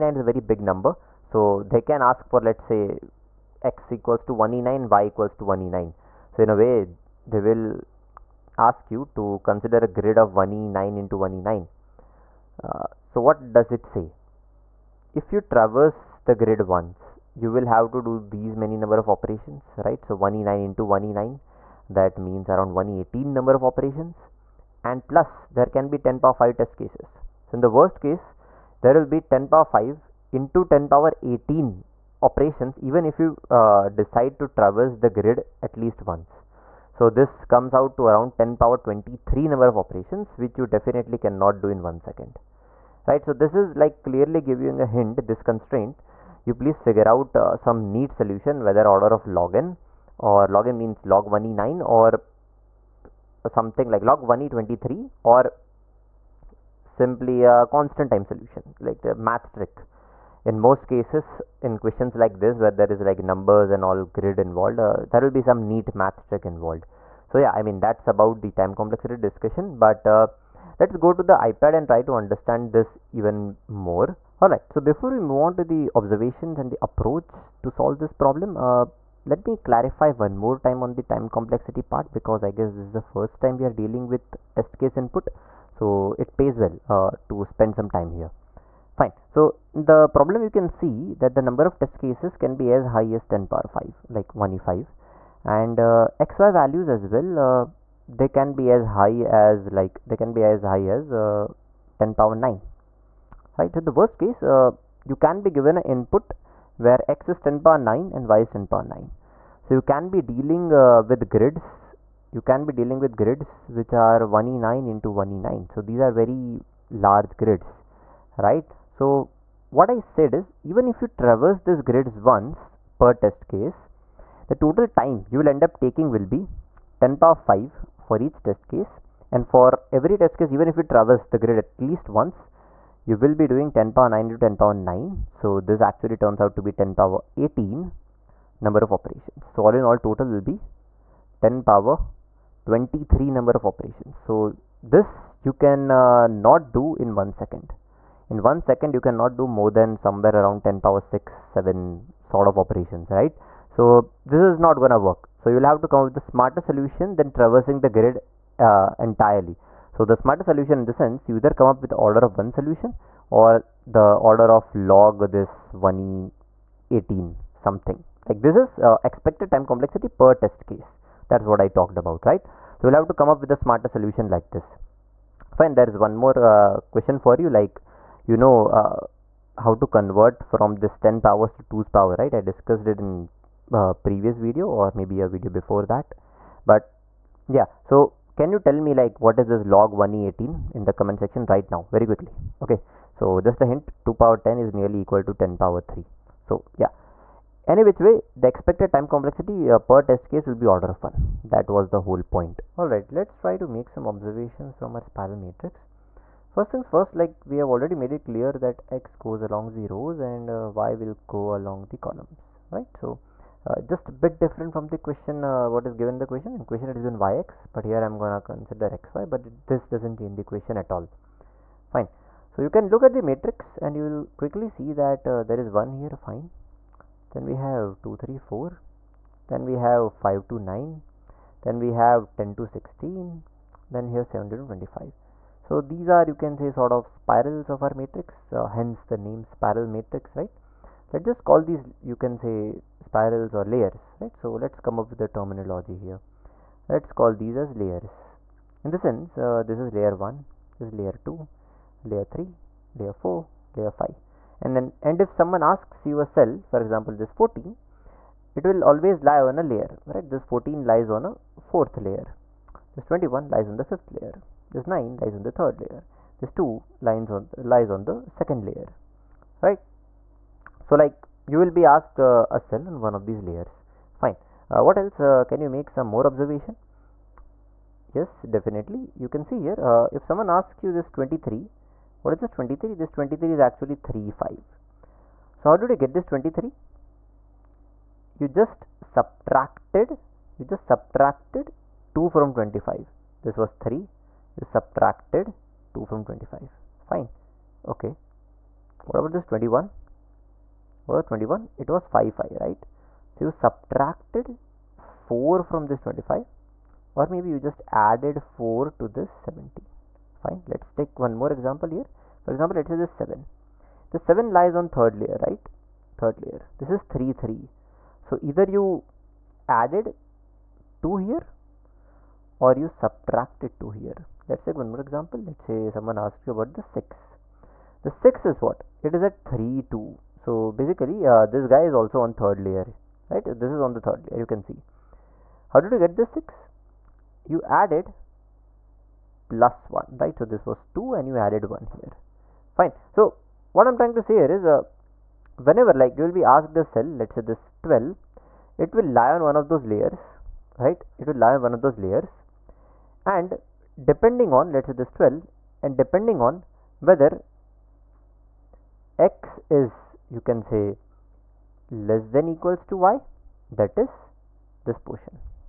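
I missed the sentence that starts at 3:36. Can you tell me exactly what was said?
In question it is given yx, but here I'm gonna consider xy, but it, this doesn't change the question at all.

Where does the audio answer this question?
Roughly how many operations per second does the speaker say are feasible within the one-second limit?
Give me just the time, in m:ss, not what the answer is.
2:30.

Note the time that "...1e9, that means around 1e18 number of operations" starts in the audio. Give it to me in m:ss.
0:20.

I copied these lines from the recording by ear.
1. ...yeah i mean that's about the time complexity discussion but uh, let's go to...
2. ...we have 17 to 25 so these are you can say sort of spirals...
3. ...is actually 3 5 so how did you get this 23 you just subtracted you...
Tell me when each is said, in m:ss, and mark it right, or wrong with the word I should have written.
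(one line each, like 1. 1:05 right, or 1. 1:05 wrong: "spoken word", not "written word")
1. 1:07 right
2. 3:54 right
3. 4:43 right.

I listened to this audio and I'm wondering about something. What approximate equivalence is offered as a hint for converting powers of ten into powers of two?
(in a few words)
2^10 ≈ 10^3.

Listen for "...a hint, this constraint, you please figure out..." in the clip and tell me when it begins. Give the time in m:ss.
0:44.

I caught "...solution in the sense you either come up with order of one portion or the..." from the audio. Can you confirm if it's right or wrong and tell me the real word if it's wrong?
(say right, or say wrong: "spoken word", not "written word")
wrong: "solution", not "portion".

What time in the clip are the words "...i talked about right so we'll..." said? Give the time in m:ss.
2:51.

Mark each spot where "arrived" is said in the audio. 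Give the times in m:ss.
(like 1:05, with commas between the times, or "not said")
not said.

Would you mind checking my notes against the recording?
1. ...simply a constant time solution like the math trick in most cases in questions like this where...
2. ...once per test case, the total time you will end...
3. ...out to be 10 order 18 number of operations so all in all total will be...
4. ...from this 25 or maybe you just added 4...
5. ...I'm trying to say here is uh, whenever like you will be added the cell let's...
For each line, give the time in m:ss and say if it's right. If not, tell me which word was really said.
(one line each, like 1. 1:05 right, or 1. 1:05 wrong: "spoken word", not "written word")
1. 0:56 right
2. 2:02 right
3. 2:16 wrong: "power", not "order"
4. 5:05 right
5. 5:43 wrong: "asked", not "added".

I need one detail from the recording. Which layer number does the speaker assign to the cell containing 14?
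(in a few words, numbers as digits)
fourth.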